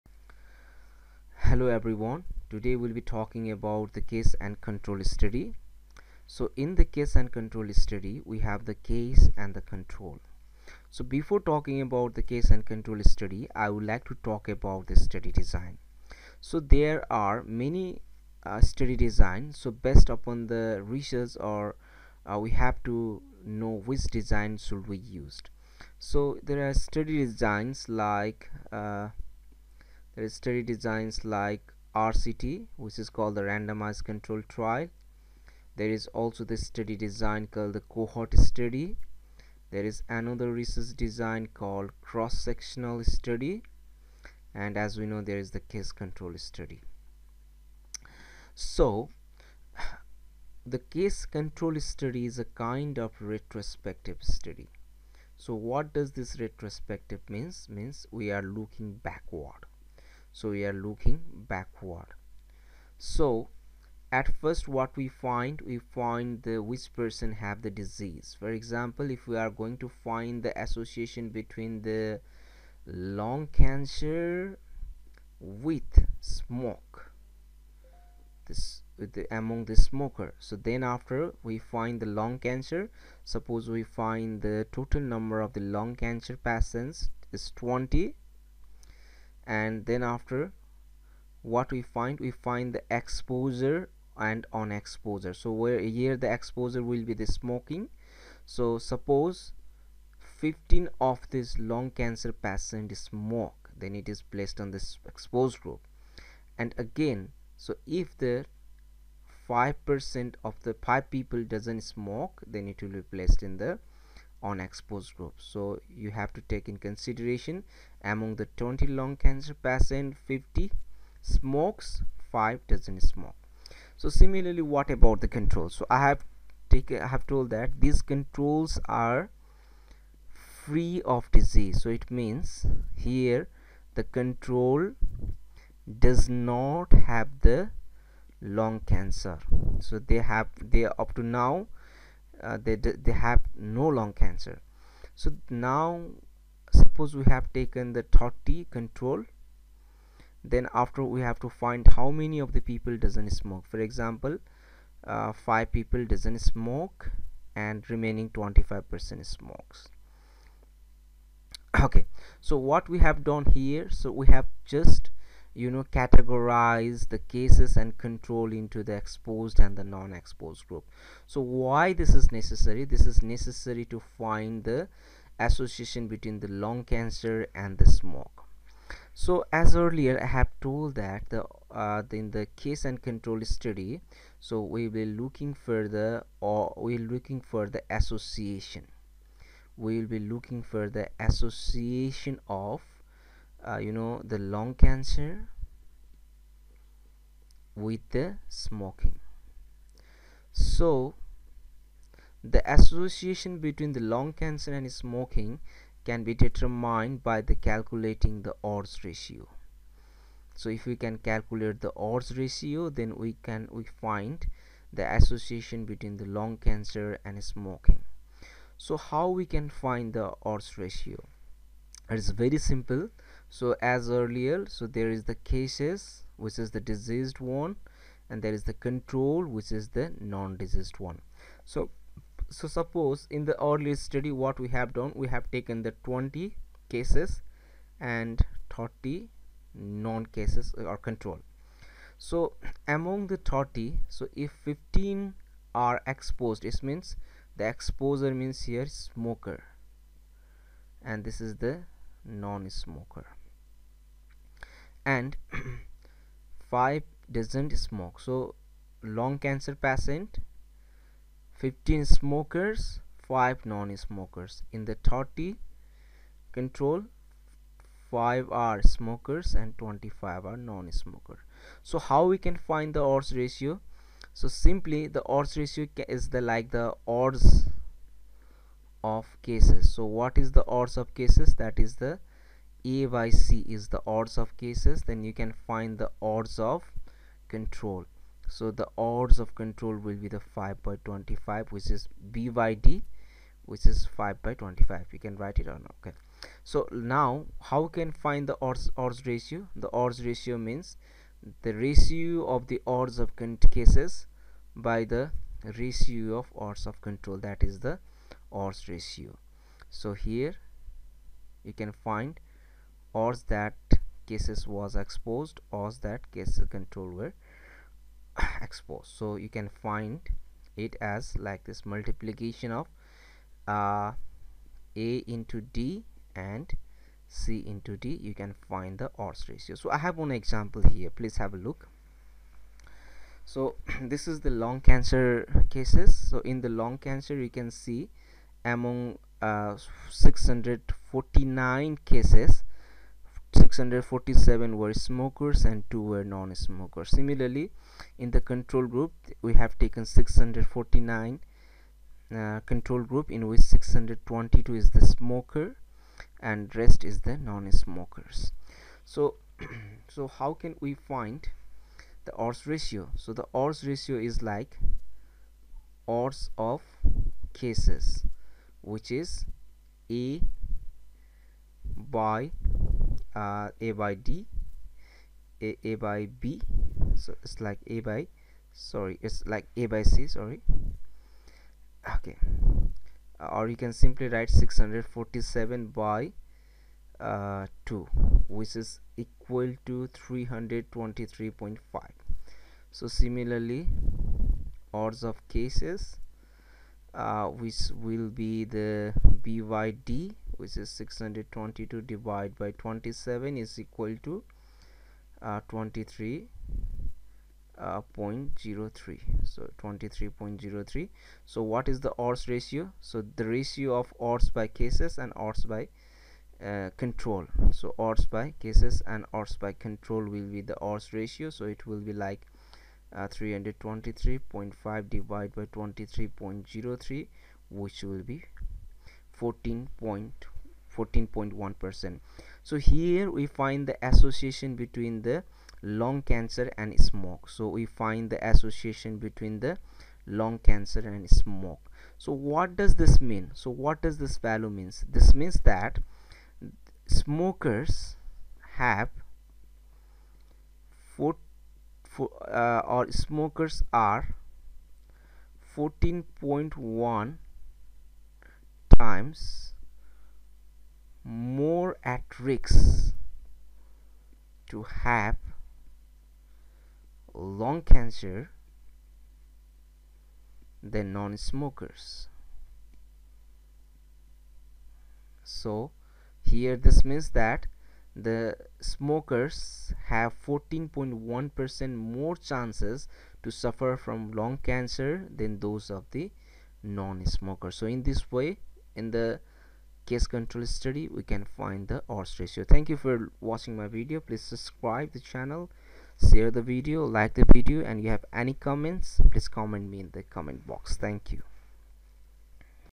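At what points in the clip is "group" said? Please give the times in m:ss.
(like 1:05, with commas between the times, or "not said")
1:45, 1:55, 2:50, 5:48, 5:53.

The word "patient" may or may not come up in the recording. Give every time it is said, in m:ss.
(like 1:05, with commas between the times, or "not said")
1:26, 1:42, 1:59, 4:19.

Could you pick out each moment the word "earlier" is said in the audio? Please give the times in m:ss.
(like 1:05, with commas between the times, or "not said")
2:59, 3:44, 3:53.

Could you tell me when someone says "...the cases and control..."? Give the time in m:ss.
2:47.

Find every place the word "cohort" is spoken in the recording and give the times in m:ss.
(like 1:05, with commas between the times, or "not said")
0:37.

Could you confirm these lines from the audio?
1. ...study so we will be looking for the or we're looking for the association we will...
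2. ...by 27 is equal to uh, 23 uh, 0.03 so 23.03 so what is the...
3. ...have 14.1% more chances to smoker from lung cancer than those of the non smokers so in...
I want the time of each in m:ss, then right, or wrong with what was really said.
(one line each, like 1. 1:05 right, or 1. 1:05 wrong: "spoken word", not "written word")
1. 3:03 right
2. 6:42 right
3. 8:00 wrong: "suffer", not "smoker".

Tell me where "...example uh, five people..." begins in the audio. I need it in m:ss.
2:33.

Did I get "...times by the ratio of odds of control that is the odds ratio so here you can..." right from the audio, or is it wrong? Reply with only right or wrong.
wrong.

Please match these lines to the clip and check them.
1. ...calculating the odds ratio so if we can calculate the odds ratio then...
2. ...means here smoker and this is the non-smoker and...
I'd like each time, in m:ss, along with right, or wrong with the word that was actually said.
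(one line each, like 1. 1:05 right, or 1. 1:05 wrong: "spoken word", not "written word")
1. 3:27 right
2. 4:08 right.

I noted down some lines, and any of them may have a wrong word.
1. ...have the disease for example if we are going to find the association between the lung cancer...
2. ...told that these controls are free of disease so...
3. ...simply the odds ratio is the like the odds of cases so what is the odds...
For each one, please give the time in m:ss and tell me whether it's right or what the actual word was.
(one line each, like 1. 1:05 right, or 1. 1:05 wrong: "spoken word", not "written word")
1. 1:07 right
2. 2:07 right
3. 4:34 right.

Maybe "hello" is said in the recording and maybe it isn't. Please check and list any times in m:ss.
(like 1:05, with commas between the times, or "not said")
0:01.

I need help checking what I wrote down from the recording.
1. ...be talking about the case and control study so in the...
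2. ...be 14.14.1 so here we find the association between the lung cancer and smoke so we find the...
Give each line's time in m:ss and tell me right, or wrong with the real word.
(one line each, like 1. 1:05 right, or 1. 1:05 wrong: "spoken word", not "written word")
1. 0:02 right
2. 7:08 right.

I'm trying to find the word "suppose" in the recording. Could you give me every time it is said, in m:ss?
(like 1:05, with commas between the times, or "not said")
1:23, 1:38, 2:26, 3:52.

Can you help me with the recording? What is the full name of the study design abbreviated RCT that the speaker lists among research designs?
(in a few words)
randomized control trial.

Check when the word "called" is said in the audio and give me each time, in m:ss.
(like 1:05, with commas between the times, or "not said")
0:33, 0:37, 0:41.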